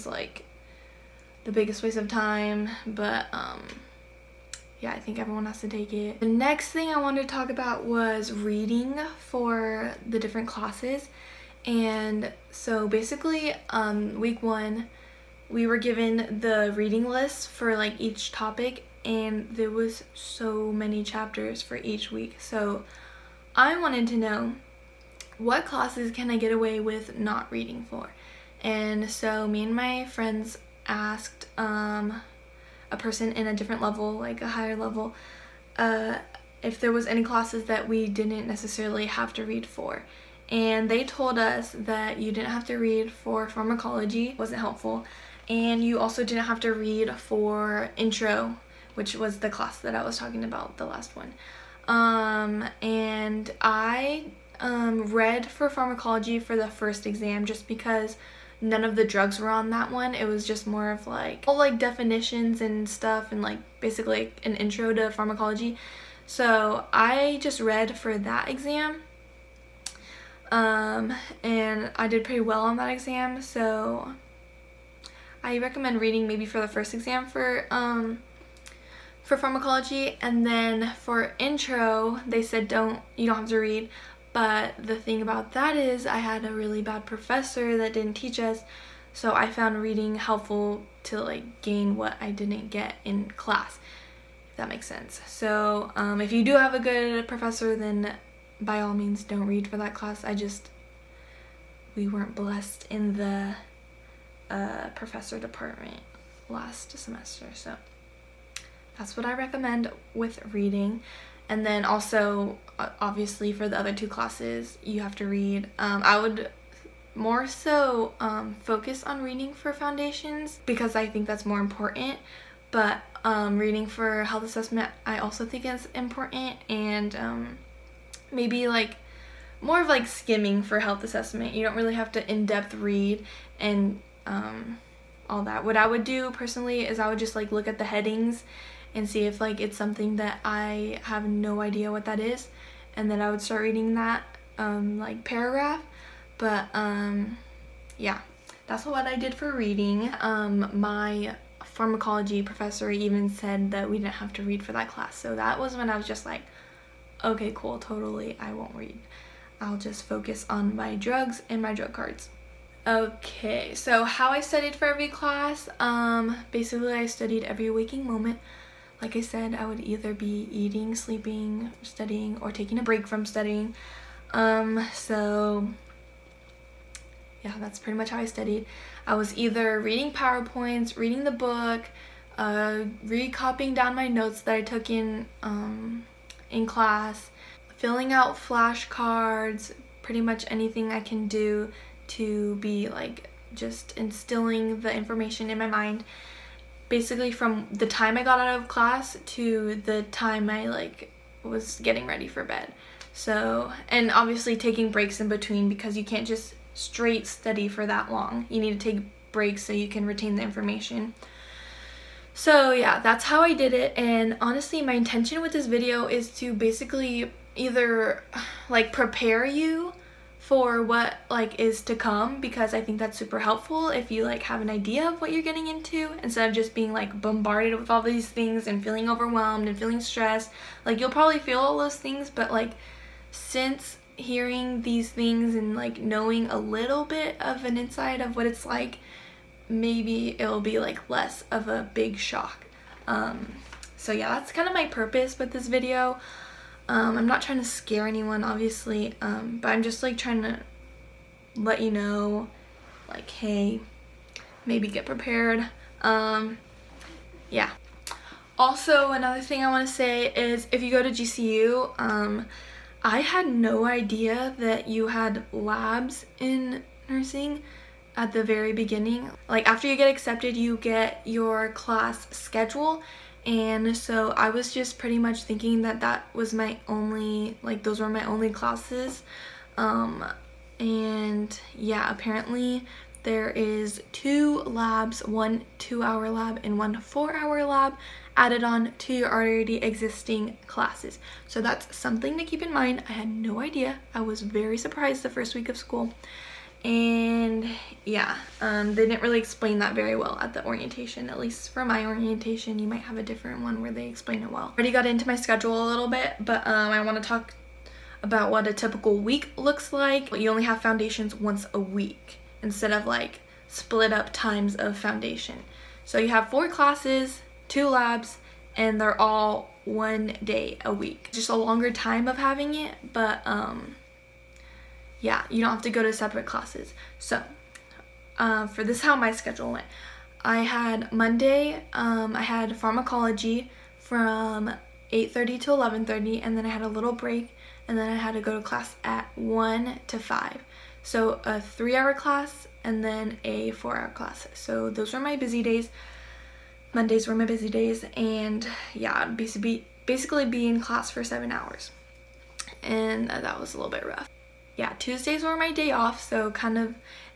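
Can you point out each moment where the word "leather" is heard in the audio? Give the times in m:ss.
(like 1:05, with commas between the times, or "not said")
not said.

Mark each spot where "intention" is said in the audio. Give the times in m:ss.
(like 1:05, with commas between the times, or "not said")
3:34.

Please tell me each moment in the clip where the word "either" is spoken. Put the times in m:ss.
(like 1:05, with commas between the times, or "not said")
2:49, 2:59, 3:37.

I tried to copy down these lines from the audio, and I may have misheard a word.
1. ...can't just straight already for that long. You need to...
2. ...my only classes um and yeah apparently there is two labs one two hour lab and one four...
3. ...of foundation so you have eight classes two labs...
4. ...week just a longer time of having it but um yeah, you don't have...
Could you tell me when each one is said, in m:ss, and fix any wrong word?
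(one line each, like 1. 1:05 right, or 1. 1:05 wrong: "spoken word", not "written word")
1. 3:26 wrong: "study", not "already"
2. 4:38 right
3. 5:14 wrong: "four", not "eight"
4. 5:20 right.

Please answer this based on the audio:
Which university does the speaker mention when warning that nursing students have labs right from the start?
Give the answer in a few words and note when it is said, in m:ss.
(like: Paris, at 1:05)
GCU, at 4:20.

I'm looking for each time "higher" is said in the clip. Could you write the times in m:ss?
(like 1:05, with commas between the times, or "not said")
0:34.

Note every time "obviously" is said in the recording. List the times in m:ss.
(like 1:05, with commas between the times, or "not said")
1:52, 3:24, 4:08.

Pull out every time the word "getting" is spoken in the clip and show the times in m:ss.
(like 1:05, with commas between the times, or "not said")
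3:21, 3:45.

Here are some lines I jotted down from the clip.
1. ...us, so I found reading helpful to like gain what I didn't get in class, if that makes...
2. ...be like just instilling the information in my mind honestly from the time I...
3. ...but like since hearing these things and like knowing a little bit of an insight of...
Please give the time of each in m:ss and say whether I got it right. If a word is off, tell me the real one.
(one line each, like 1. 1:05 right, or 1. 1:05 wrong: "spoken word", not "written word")
1. 1:28 right
2. 3:12 wrong: "basically", not "honestly"
3. 3:52 right.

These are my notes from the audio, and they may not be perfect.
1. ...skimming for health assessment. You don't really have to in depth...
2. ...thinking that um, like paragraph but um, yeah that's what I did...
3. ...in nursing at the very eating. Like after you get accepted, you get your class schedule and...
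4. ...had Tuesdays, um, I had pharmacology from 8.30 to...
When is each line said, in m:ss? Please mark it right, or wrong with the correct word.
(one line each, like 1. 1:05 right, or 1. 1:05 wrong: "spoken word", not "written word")
1. 2:10 right
2. 2:23 wrong: "reading", not "thinking"
3. 4:26 wrong: "beginning", not "eating"
4. 5:30 wrong: "Monday", not "Tuesdays".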